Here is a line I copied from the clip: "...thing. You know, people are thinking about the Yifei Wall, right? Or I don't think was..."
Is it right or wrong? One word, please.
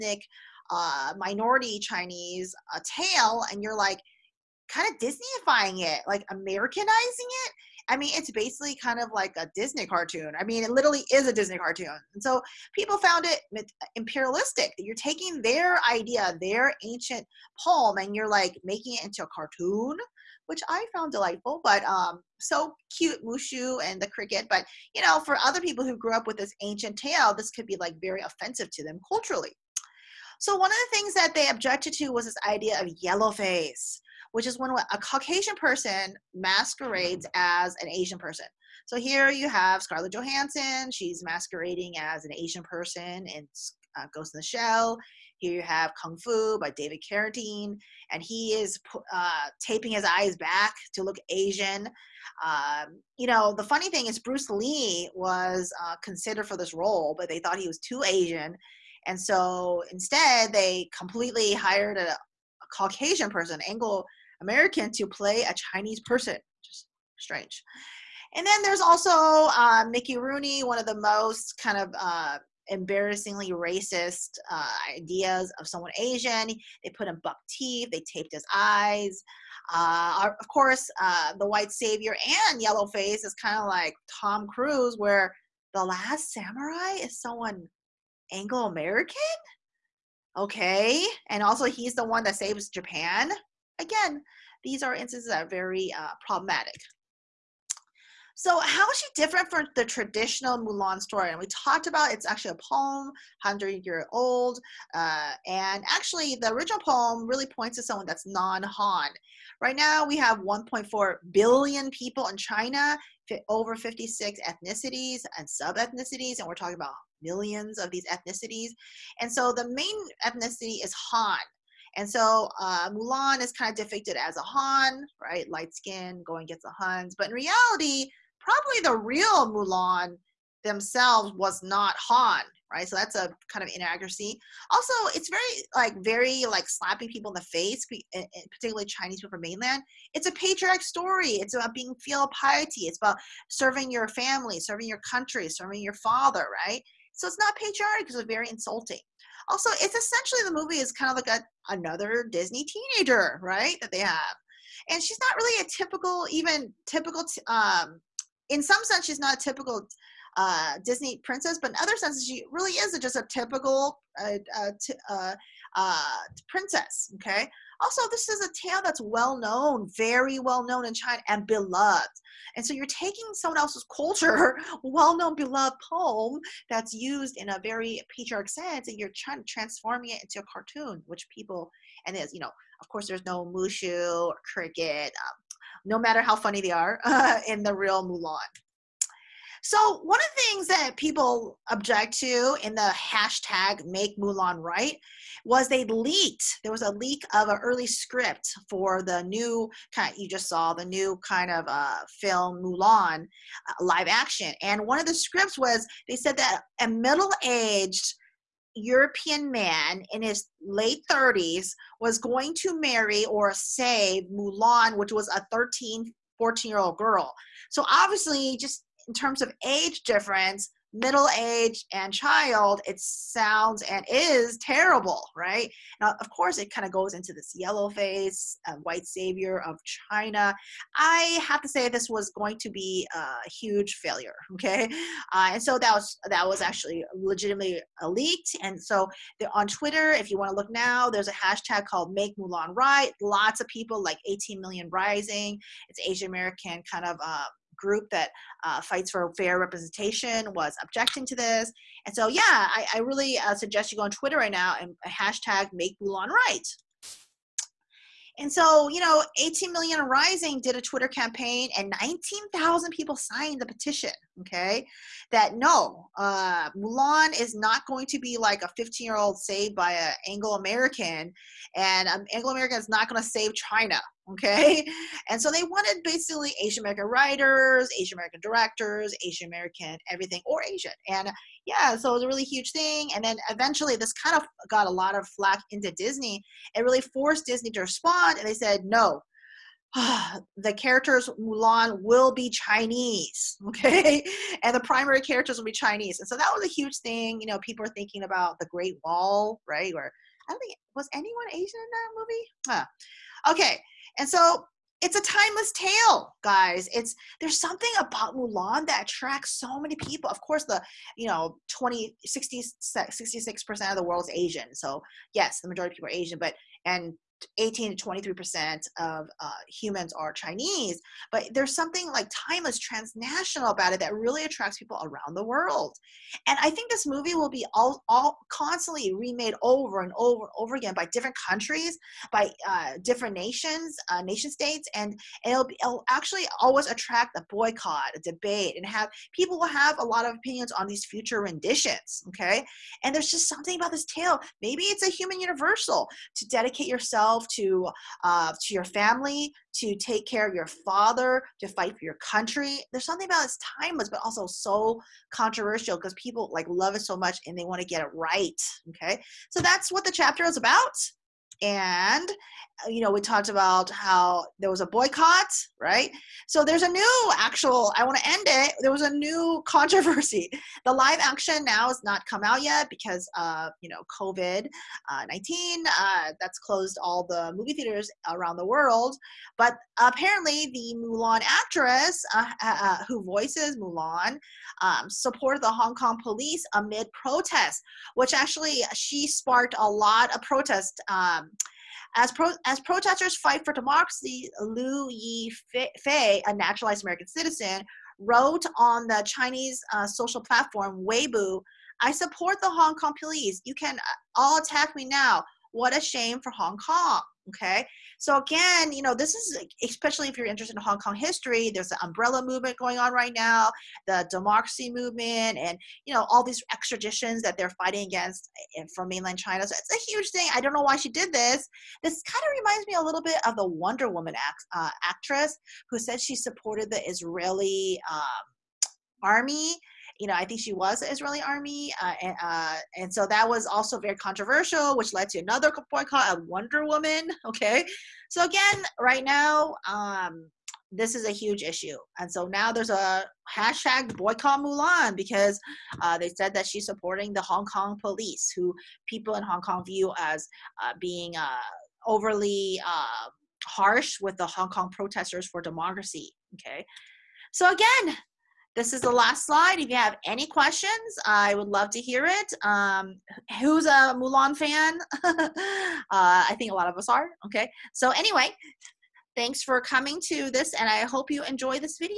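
wrong.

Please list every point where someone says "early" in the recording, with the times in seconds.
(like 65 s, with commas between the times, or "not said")
197 s.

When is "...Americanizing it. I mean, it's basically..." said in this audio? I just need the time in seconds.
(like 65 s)
6 s.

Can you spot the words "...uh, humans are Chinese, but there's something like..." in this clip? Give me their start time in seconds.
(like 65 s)
319 s.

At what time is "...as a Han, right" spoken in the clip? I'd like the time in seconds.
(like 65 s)
124 s.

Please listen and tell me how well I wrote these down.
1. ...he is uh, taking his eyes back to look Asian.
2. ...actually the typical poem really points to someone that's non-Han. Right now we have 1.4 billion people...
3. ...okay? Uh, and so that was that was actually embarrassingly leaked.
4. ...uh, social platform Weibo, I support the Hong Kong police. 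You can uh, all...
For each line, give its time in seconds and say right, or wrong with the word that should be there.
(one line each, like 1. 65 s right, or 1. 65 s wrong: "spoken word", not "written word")
1. 48 s wrong: "taping", not "taking"
2. 105 s wrong: "original", not "typical"
3. 234 s wrong: "legitimately", not "embarrassingly"
4. 399 s right.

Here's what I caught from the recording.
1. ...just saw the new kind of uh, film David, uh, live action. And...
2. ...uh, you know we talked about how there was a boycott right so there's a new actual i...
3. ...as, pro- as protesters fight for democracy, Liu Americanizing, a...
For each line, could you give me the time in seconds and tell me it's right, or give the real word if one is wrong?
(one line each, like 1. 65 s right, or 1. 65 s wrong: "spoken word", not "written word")
1. 200 s wrong: "Mulan", not "David"
2. 362 s right
3. 392 s wrong: "Yifei", not "Americanizing".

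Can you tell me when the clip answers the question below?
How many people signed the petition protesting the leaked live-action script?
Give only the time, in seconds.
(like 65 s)
261 s.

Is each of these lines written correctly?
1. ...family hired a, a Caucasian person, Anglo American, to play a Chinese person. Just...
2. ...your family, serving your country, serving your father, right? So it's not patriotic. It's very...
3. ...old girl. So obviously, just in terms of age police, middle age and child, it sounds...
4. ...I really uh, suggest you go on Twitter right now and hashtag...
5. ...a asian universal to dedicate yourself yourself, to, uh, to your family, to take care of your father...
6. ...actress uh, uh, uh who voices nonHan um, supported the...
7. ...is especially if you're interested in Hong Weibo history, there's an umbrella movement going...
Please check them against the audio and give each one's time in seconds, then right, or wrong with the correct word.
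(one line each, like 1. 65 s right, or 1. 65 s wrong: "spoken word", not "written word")
1. 60 s wrong: "completely", not "family"
2. 143 s right
3. 216 s wrong: "difference", not "police"
4. 252 s right
5. 345 s wrong: "human", not "asian"
6. 381 s wrong: "mulan", not "nonHan"
7. 409 s wrong: "Kong", not "Weibo".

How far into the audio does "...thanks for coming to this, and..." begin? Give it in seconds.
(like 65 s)
469 s.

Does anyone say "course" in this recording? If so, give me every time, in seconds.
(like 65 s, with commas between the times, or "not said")
80 s, 182 s, 226 s, 310 s.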